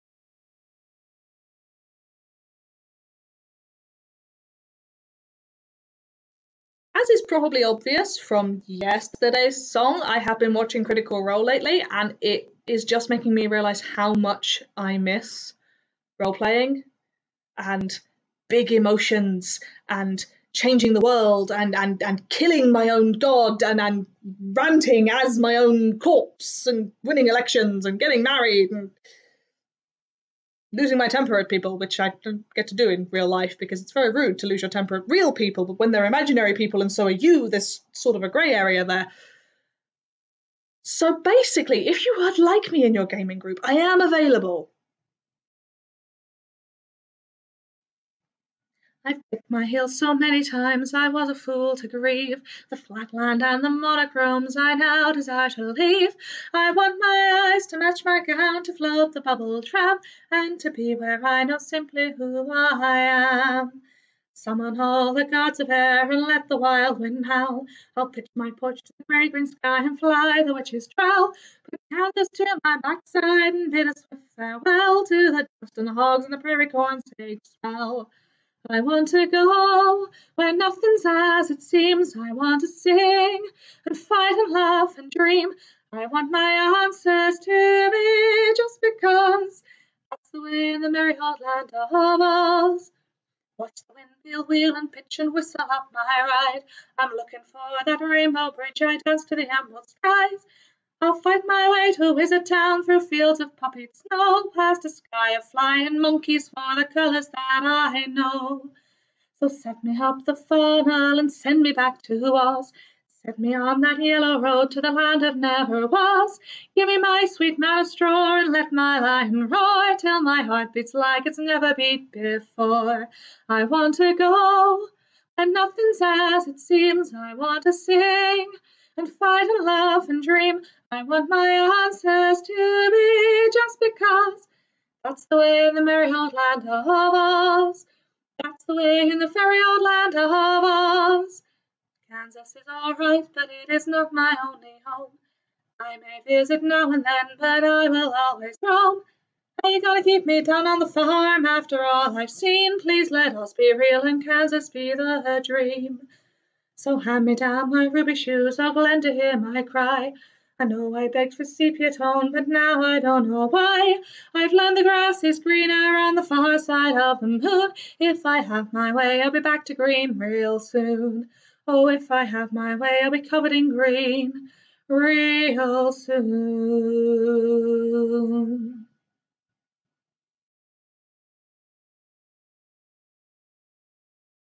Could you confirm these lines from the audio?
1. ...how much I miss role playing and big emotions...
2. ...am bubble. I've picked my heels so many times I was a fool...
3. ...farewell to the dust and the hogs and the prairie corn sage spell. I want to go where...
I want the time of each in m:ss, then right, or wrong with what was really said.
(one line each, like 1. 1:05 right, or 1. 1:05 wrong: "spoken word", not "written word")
1. 0:13 right
2. 0:43 wrong: "available", not "bubble"
3. 1:14 right.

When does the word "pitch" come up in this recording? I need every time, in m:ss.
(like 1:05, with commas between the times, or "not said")
1:08, 1:34.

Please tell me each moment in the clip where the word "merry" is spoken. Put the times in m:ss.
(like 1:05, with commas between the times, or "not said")
1:30, 2:15.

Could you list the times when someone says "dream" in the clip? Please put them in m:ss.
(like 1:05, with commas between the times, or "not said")
1:25, 2:10, 2:35.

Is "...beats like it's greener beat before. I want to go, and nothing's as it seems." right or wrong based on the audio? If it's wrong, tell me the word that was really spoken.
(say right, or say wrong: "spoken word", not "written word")
wrong: "never", not "greener".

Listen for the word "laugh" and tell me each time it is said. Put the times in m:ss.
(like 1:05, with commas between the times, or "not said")
1:24, 2:09.